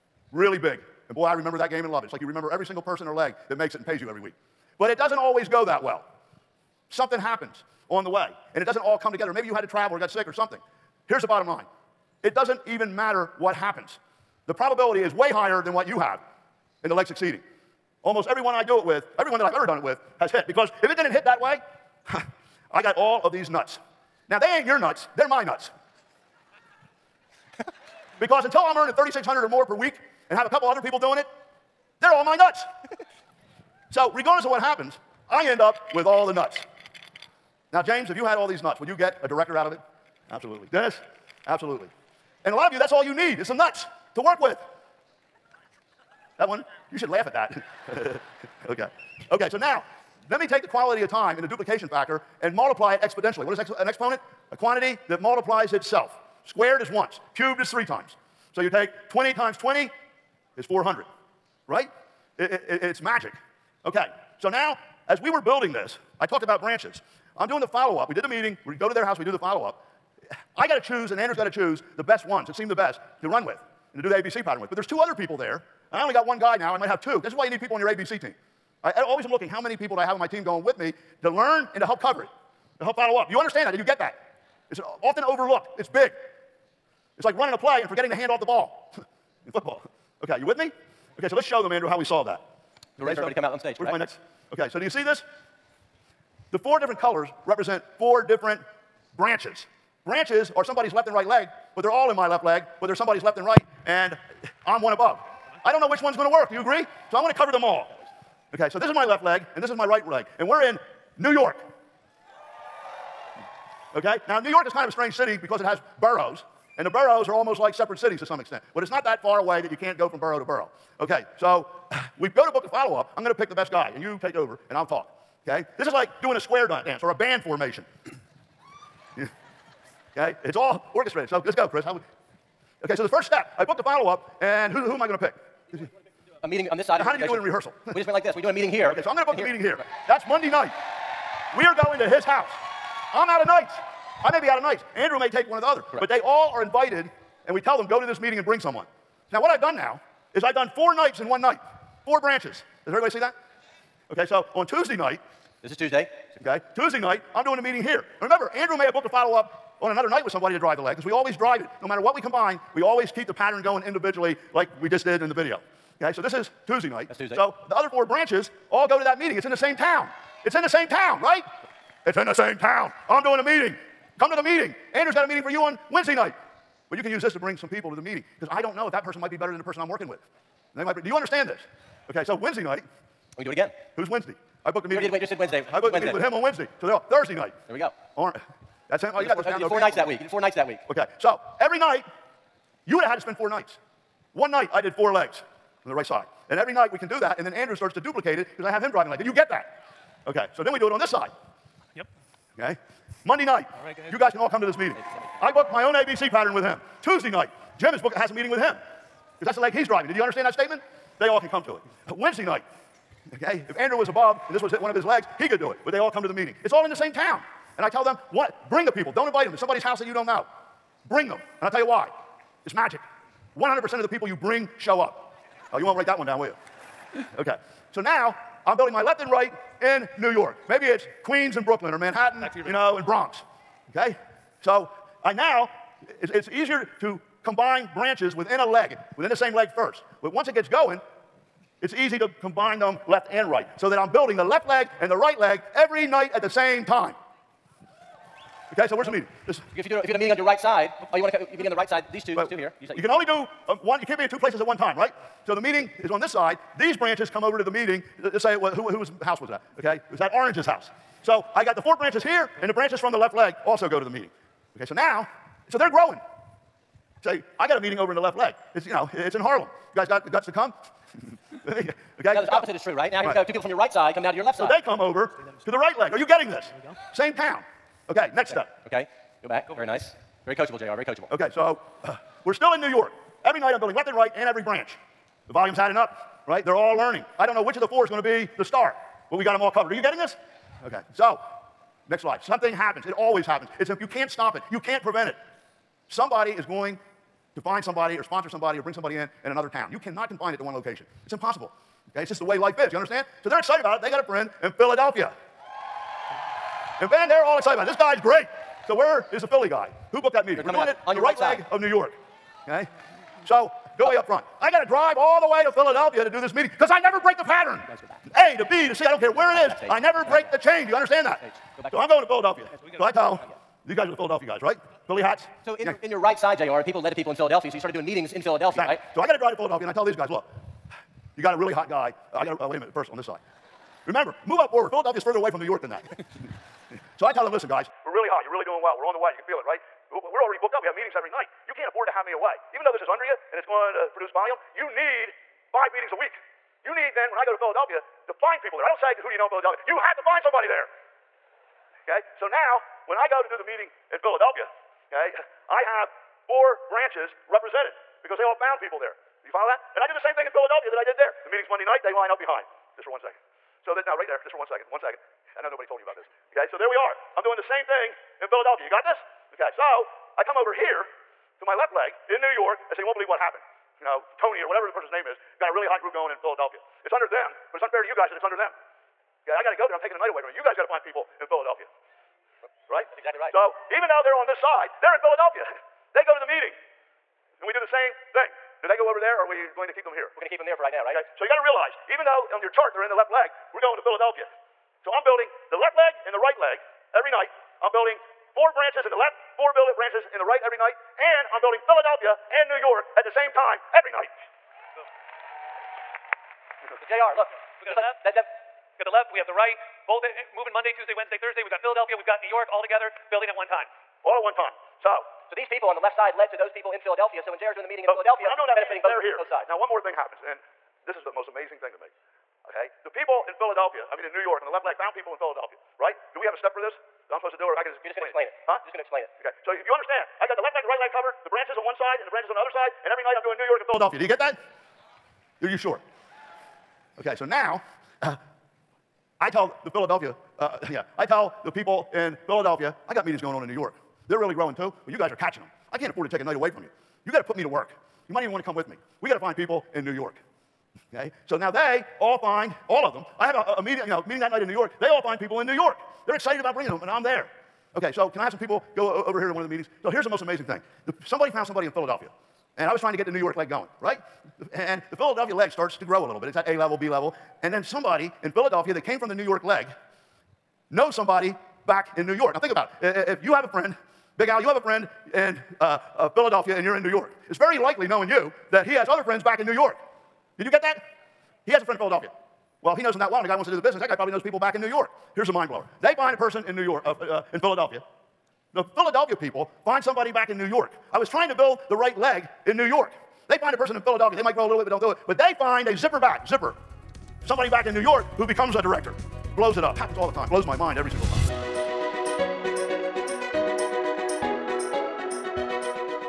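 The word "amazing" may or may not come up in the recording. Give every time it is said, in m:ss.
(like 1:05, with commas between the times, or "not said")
7:01, 7:40.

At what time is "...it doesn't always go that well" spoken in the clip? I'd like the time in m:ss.
0:04.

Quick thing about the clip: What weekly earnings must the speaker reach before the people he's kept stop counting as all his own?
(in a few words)
3600.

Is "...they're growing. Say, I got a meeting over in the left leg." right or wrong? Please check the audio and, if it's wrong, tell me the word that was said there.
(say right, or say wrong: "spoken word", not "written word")
right.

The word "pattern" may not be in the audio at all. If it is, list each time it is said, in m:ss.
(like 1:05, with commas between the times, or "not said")
1:14, 2:43, 3:26, 5:17.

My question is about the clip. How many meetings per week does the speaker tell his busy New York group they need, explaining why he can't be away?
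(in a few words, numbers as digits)
five.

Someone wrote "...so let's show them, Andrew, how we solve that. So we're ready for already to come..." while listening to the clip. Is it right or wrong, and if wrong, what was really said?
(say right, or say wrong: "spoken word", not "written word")
wrong: "everybody", not "already".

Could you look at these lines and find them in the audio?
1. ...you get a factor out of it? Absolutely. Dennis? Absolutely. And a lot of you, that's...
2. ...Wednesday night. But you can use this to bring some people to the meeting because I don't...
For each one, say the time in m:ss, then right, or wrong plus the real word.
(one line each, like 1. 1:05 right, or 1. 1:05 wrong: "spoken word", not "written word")
1. 0:38 wrong: "director", not "factor"
2. 2:55 right.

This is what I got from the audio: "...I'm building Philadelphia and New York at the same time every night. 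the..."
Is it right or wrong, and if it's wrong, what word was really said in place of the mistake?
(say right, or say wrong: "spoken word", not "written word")
right.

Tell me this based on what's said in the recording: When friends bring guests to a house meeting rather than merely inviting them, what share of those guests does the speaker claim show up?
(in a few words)
100%.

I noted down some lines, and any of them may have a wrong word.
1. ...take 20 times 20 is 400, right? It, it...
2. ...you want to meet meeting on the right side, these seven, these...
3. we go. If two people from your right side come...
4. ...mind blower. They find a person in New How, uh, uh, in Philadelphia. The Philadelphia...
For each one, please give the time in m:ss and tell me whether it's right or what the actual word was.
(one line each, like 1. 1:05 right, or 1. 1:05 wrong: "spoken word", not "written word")
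1. 0:58 right
2. 4:11 wrong: "two", not "seven"
3. 4:33 right
4. 8:05 wrong: "York", not "How".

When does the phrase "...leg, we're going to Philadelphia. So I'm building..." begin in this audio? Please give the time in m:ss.
6:33.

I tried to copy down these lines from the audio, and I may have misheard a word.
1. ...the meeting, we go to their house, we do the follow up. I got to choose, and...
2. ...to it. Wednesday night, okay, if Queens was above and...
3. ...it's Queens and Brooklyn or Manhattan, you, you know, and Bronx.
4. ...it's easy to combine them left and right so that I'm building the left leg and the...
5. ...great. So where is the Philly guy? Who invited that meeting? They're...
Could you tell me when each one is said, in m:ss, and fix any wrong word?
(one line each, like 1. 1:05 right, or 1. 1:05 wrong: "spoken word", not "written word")
1. 1:08 right
2. 3:31 wrong: "Andrew", not "Queens"
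3. 3:50 right
4. 4:01 right
5. 5:08 wrong: "booked", not "invited".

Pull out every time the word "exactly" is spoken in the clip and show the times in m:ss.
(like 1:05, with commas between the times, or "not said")
5:28, 6:23.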